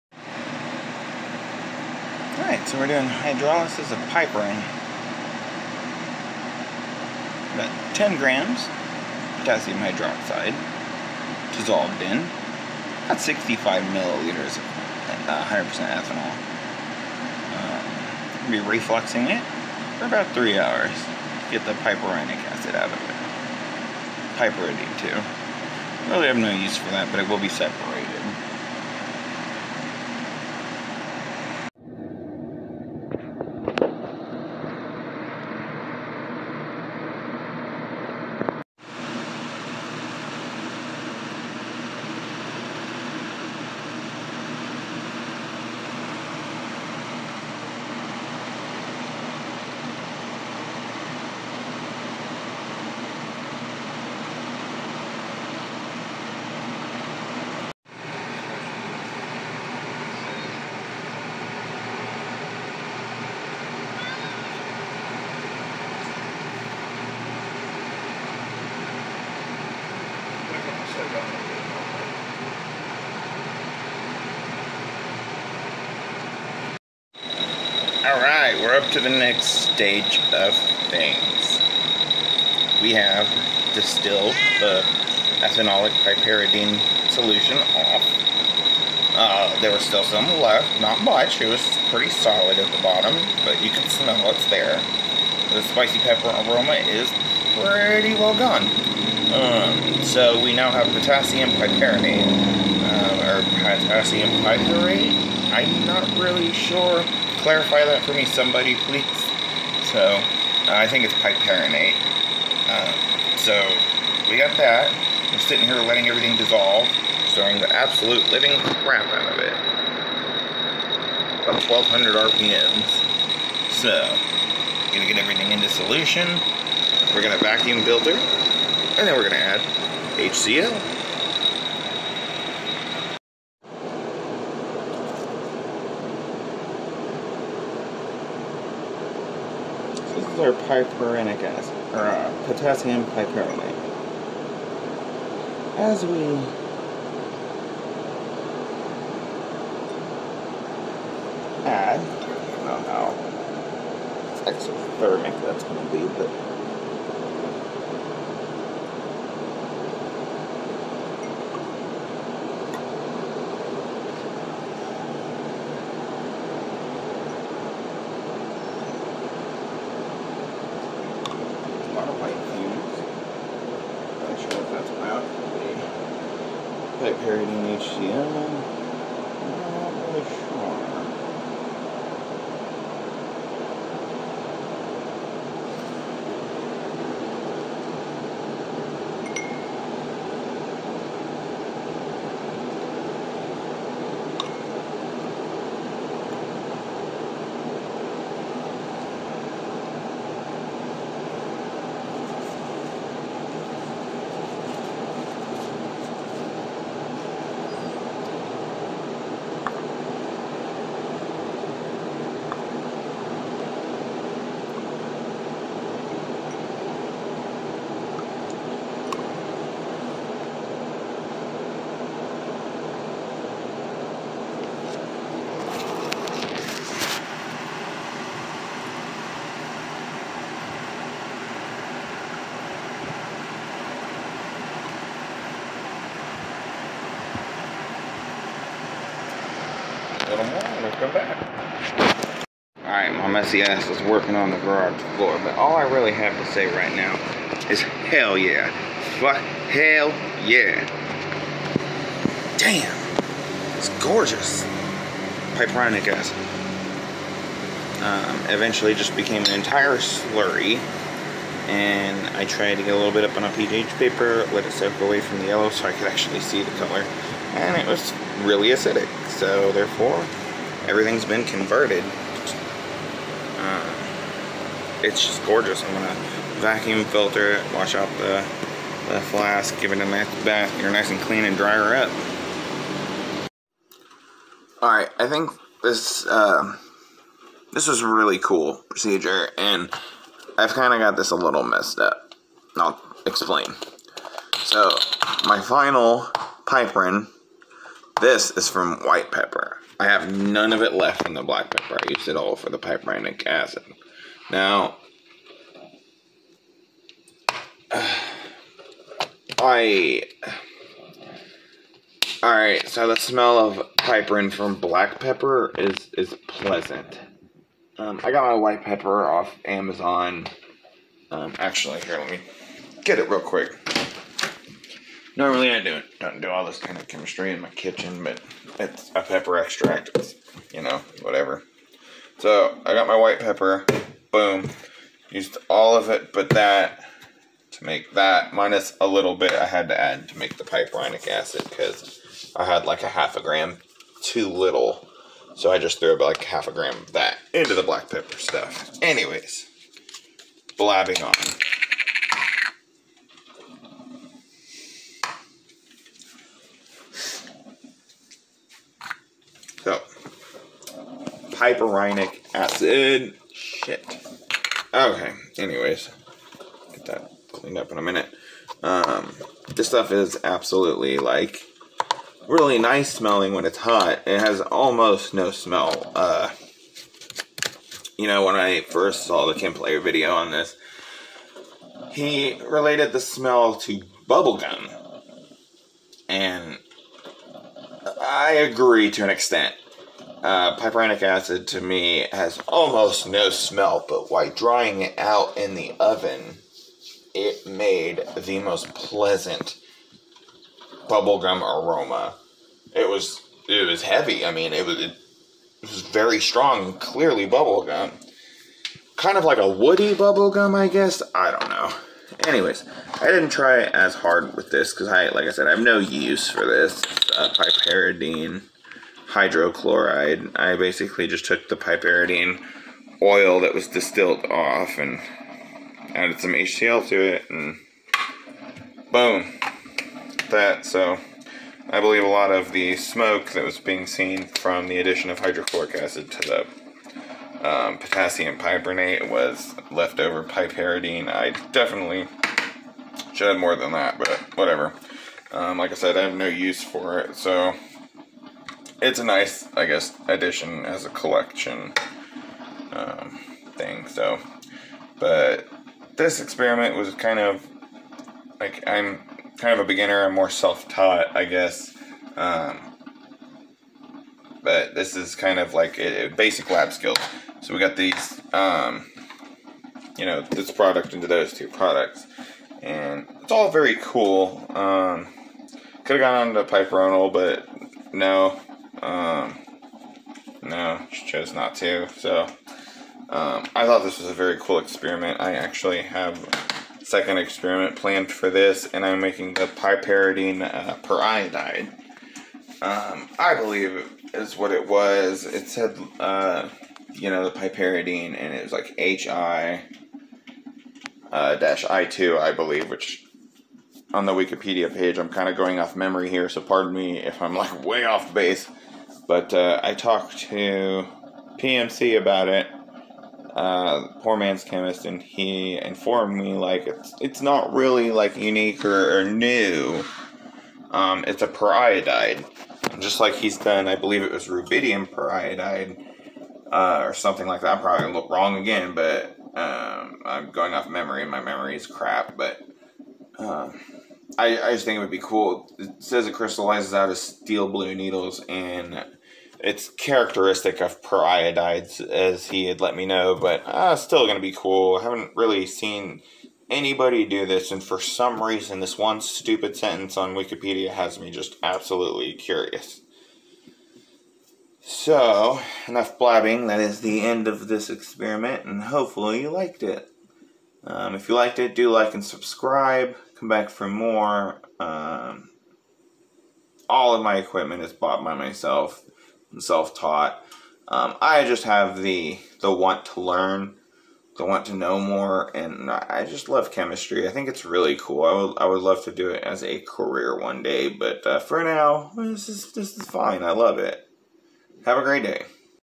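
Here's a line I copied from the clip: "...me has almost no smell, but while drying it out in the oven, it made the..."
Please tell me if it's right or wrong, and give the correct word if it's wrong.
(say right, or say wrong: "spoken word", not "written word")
right.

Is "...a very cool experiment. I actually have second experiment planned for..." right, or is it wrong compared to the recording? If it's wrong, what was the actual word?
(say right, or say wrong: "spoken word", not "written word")
right.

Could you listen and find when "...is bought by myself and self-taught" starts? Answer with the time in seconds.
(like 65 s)
567 s.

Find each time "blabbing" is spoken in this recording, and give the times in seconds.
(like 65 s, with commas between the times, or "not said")
350 s, 556 s.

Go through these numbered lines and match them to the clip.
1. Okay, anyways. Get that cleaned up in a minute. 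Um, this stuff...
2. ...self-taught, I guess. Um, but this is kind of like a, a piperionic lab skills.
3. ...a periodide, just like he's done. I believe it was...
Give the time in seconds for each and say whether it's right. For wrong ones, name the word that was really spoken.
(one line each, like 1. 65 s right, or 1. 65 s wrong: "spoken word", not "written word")
1. 364 s right
2. 460 s wrong: "basic", not "piperionic"
3. 521 s right.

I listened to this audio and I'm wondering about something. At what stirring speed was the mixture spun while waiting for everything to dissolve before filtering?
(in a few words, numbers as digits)
1200 RPM.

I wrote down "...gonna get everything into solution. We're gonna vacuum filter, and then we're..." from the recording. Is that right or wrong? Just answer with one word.
right.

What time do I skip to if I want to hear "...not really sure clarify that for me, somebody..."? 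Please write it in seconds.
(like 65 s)
105 s.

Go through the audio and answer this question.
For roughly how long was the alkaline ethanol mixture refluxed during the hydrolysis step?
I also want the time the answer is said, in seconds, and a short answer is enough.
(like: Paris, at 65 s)
3 hours, at 20 s.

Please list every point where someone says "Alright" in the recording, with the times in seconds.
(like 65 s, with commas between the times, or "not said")
2 s, 78 s, 242 s, 312 s.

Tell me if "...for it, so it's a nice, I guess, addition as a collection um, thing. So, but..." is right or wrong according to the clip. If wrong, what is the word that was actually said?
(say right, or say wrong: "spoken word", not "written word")
right.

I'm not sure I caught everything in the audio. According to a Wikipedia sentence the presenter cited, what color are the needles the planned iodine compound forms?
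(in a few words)
Steel blue.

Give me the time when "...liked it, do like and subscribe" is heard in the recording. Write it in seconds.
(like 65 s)
561 s.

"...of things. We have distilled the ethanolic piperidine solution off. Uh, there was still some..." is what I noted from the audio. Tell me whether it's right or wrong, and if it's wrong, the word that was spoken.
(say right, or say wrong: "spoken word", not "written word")
right.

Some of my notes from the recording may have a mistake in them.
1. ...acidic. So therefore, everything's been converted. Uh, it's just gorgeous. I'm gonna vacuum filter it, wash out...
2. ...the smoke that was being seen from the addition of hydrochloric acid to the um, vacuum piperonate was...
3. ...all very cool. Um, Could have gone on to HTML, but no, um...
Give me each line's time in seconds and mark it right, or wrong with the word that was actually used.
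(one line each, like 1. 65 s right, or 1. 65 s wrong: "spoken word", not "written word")
1. 268 s right
2. 432 s wrong: "potassium", not "vacuum"
3. 473 s wrong: "Piperonal", not "HTML".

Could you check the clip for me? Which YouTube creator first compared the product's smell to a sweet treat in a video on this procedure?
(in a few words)
Chemplayer.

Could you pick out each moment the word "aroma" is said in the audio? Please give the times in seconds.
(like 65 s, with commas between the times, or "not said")
96 s, 401 s.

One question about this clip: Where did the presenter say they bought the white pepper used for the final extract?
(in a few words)
Amazon.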